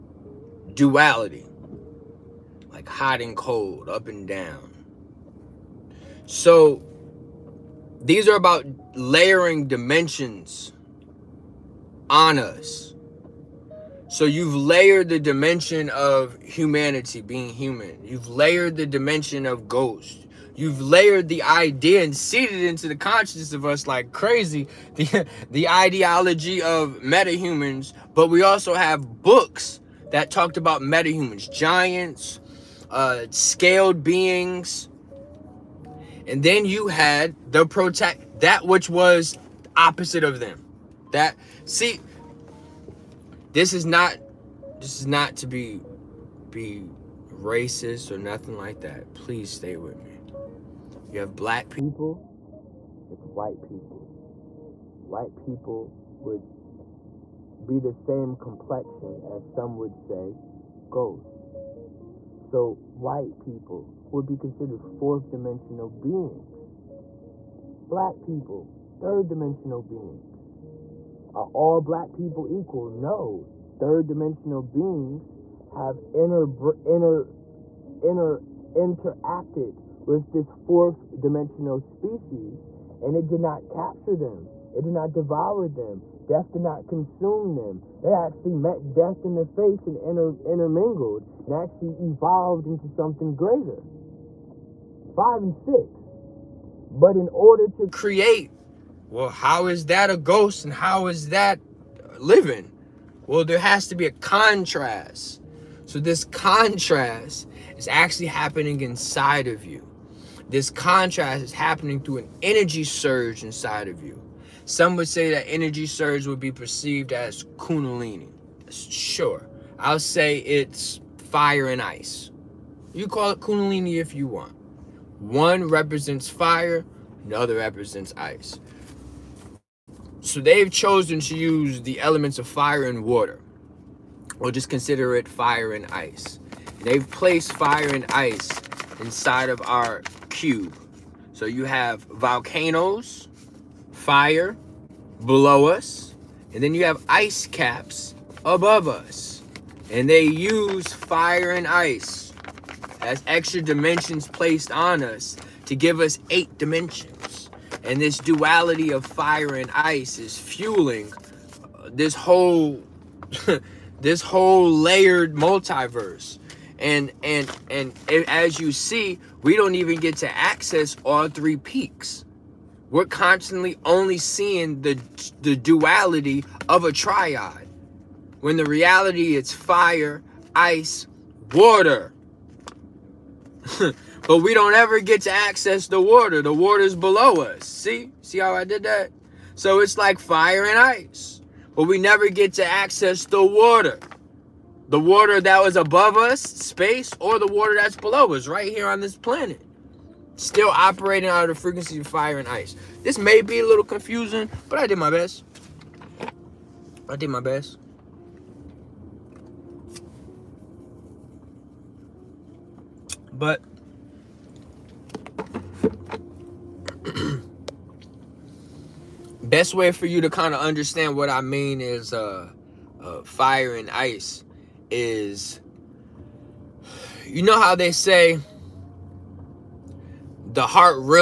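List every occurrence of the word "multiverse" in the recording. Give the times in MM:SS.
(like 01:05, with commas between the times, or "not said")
02:45.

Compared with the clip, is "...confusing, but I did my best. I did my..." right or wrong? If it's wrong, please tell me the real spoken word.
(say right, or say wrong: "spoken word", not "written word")
right.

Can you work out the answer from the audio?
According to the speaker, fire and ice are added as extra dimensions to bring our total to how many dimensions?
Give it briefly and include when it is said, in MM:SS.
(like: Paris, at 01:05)
8, at 02:36.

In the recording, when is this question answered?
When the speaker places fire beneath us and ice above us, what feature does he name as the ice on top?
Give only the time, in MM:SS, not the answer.
02:27.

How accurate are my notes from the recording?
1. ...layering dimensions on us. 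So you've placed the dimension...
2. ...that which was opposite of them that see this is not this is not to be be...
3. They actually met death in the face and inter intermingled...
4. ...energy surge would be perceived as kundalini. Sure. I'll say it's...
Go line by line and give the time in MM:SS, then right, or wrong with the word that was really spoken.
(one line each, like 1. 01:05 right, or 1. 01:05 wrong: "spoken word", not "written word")
1. 00:08 wrong: "layered", not "placed"
2. 00:38 right
3. 01:28 right
4. 01:55 right.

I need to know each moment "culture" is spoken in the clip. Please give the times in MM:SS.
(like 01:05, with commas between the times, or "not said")
not said.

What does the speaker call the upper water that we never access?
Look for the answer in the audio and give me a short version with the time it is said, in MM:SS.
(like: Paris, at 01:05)
Space, at 03:16.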